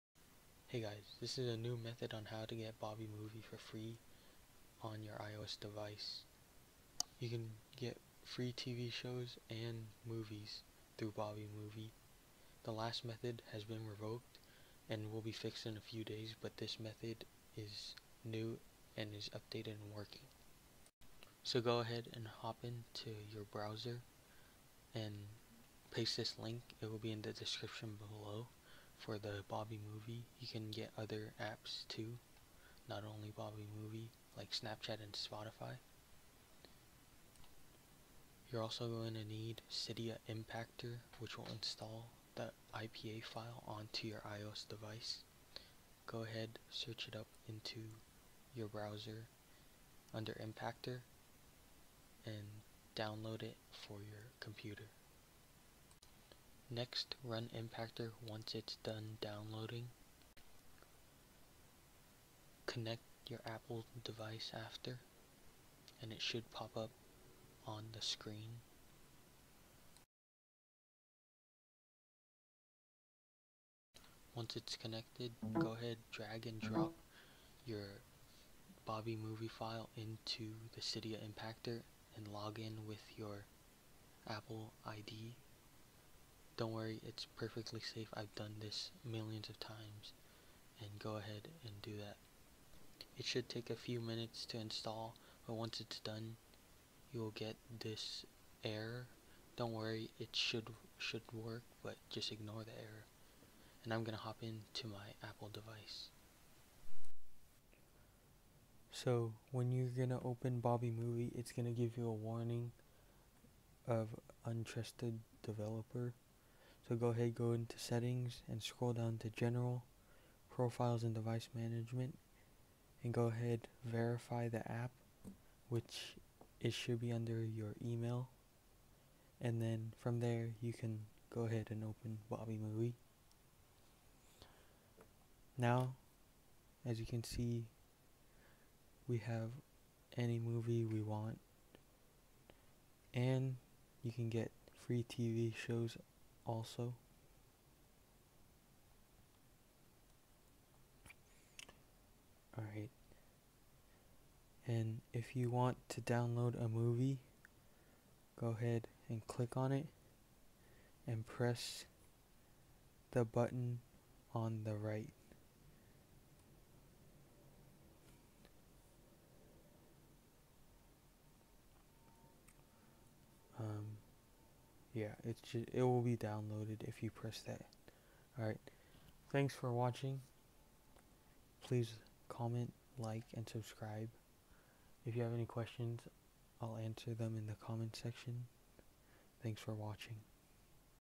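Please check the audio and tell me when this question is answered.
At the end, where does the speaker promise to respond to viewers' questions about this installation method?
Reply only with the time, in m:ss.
3:07.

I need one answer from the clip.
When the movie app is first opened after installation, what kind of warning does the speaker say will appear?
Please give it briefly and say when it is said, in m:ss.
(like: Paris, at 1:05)
Untrusted developer, at 1:54.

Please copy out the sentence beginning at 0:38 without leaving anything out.
You're also going to need Cydia Impactor, which will install the IPA file onto your iOS device.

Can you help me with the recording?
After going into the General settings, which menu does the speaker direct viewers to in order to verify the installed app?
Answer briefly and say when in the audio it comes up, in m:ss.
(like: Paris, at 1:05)
Profiles and device management, at 2:00.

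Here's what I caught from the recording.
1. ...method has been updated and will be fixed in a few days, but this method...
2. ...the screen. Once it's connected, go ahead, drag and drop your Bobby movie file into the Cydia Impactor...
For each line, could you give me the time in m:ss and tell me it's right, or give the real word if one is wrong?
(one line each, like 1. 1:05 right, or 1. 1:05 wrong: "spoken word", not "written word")
1. 0:13 wrong: "revoked", not "updated"
2. 1:07 right.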